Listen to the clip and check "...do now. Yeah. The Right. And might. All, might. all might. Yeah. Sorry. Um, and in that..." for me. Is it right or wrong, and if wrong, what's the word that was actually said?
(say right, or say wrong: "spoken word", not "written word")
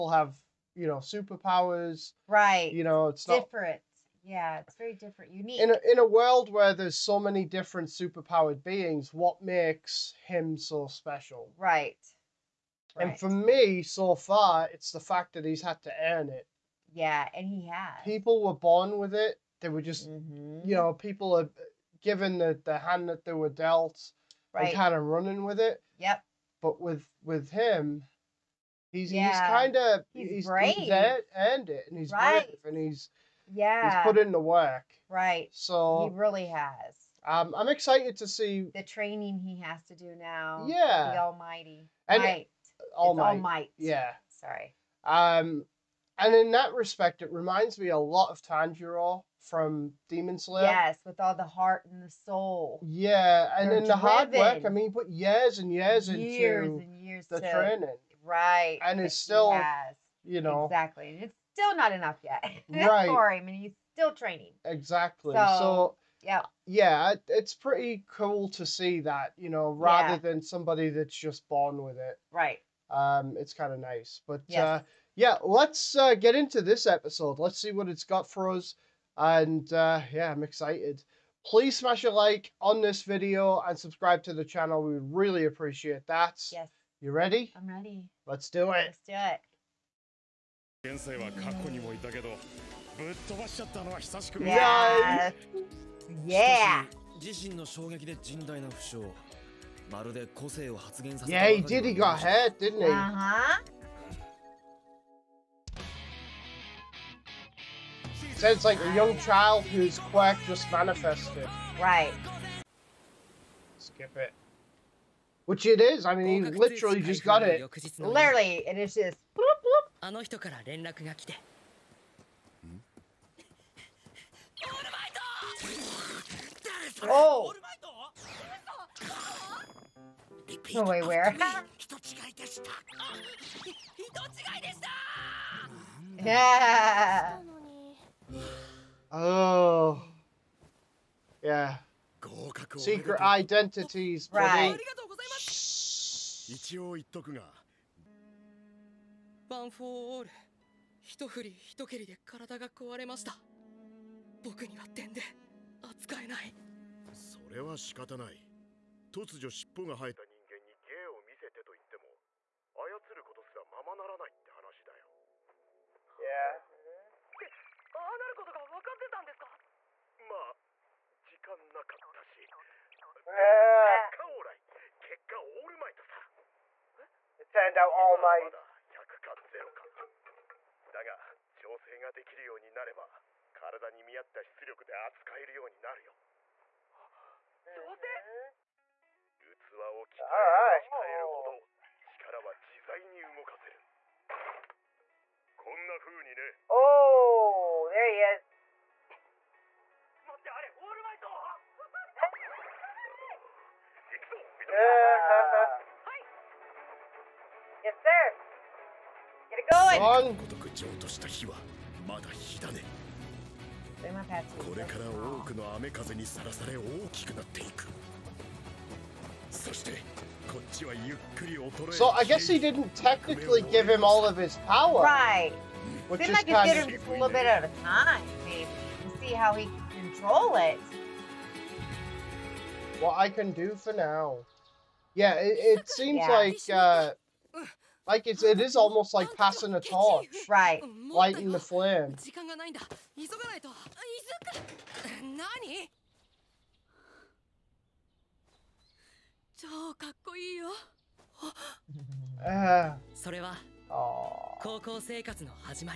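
wrong: "Almighty", not "Right".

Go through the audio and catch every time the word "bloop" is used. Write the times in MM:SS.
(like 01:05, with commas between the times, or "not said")
01:59, 02:07.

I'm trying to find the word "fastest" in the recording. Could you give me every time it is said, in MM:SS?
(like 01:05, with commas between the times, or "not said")
not said.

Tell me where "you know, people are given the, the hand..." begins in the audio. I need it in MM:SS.
00:20.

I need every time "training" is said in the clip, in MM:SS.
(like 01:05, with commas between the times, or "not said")
00:38, 00:57, 01:04.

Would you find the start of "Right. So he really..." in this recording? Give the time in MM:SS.
00:35.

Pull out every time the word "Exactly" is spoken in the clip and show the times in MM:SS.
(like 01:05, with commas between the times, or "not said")
01:00, 01:04.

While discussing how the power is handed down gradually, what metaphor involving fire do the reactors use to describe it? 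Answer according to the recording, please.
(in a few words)
passing a torch.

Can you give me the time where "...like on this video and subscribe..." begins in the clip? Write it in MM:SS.
01:22.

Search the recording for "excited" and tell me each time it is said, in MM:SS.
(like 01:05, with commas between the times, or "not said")
00:37, 01:20.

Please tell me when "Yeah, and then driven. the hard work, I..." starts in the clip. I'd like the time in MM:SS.
00:52.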